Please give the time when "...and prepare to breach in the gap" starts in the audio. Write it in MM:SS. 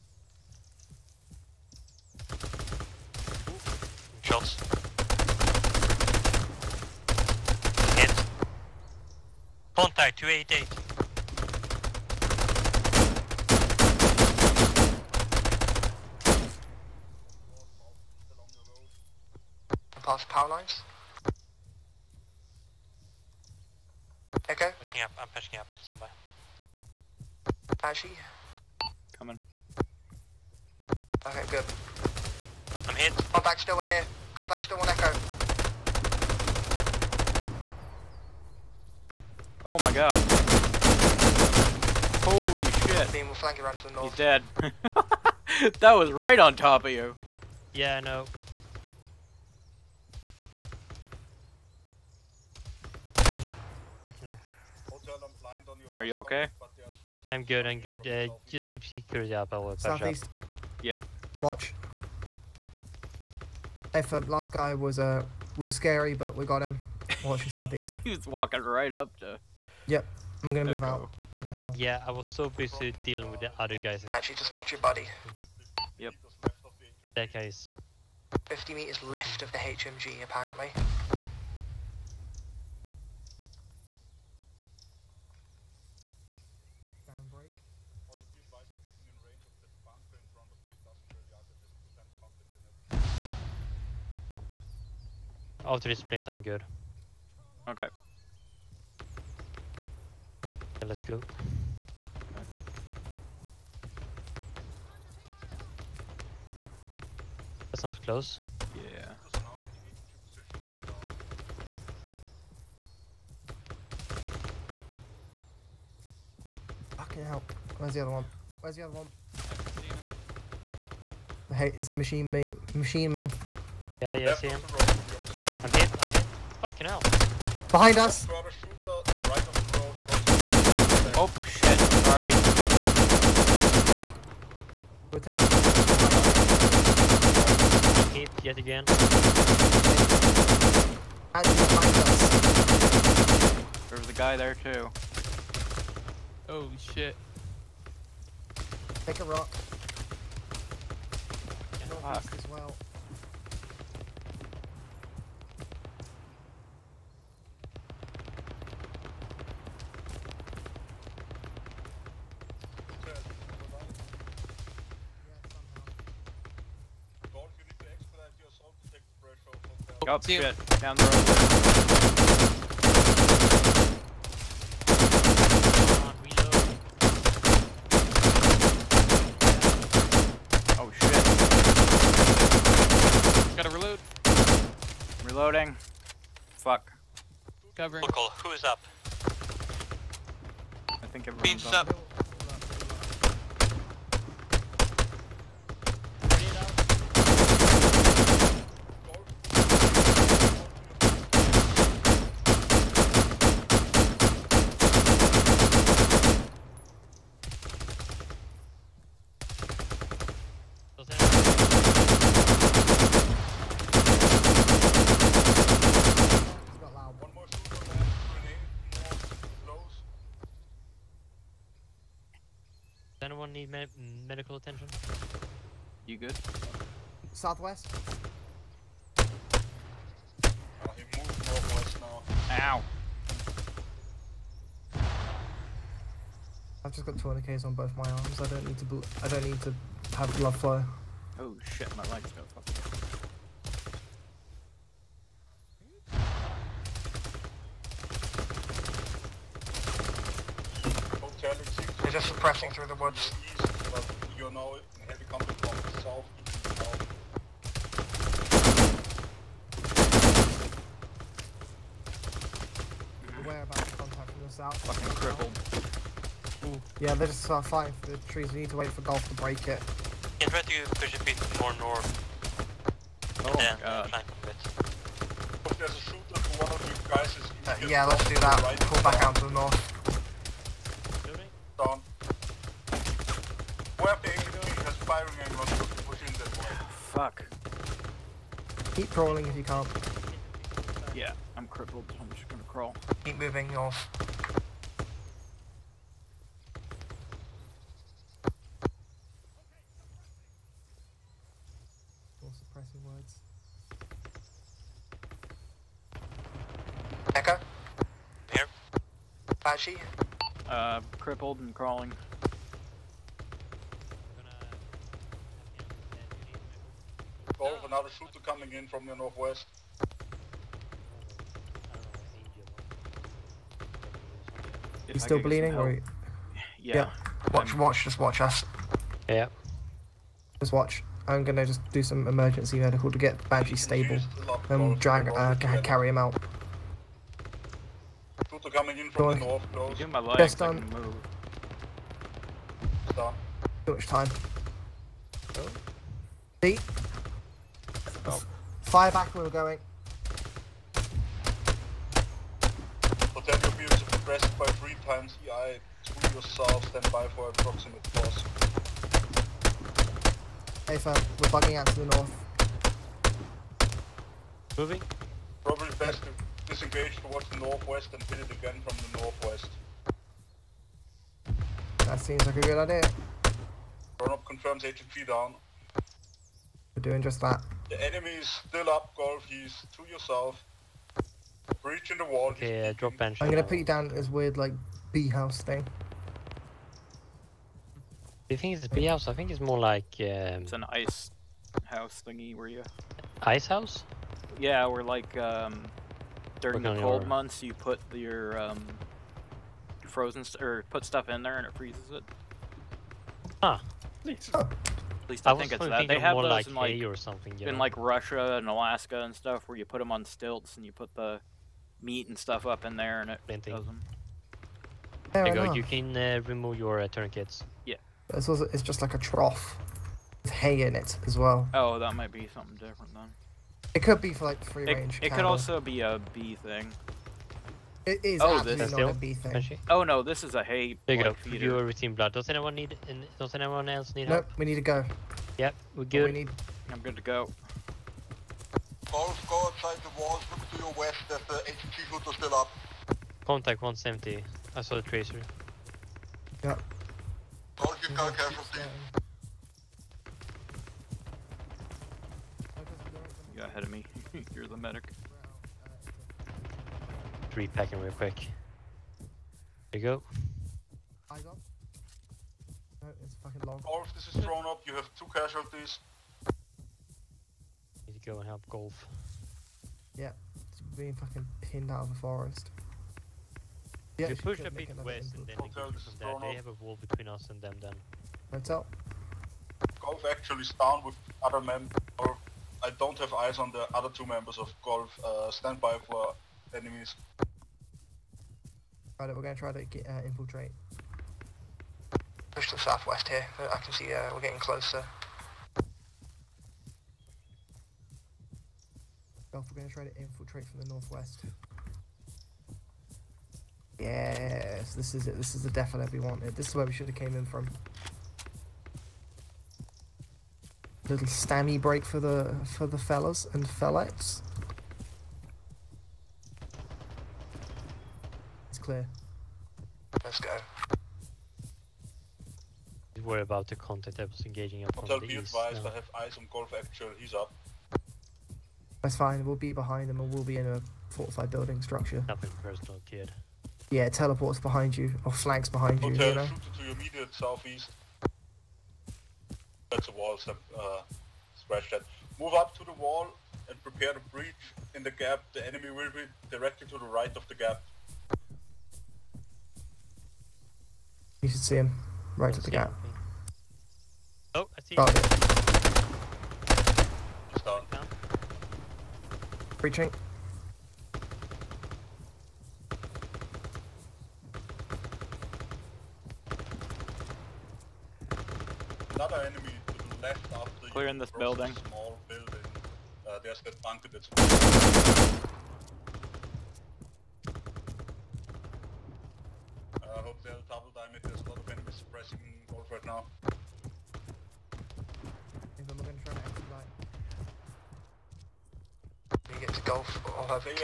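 09:03.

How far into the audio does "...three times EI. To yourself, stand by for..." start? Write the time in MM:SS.
05:54.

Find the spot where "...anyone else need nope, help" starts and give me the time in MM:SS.
07:13.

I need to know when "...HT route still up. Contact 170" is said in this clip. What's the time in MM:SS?
07:21.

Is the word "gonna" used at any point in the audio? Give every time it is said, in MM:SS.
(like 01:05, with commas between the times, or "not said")
01:10, 04:52, 05:31, 06:23.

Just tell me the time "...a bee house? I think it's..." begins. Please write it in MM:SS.
06:28.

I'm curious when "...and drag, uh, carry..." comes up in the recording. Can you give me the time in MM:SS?
05:34.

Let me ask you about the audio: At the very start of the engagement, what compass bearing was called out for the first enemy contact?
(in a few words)
288.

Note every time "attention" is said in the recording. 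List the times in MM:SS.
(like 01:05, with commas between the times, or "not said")
03:44.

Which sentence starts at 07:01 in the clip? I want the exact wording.
Oh, that might be something different then.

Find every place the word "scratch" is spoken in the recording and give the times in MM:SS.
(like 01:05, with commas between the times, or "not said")
09:01.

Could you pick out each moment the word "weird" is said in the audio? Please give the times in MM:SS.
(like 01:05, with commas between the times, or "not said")
06:24.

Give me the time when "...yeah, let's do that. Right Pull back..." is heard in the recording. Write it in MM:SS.
04:37.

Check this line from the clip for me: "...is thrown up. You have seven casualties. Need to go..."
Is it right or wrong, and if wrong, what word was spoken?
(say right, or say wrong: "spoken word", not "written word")
wrong: "two", not "seven".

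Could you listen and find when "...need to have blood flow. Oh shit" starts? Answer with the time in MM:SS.
03:59.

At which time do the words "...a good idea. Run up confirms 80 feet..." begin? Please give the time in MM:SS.
06:12.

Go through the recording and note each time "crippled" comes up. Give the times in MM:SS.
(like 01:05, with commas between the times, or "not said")
04:25, 04:51, 05:11.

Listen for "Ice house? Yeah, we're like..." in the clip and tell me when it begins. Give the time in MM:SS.
06:33.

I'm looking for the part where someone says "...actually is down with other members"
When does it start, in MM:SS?
08:00.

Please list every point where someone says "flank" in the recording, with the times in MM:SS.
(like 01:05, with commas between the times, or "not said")
00:43, 08:55.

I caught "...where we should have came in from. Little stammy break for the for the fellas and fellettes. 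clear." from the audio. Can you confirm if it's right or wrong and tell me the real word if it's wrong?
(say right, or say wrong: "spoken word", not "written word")
right.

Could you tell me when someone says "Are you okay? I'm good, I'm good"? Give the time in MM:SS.
00:55.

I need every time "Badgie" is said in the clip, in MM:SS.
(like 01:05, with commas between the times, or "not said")
05:33.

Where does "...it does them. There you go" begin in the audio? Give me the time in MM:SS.
06:53.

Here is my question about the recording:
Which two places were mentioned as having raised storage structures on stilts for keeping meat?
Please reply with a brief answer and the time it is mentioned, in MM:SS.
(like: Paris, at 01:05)
Russia and Alaska, at 06:47.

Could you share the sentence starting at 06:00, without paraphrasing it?
Hey fam, we're bugging out to the north.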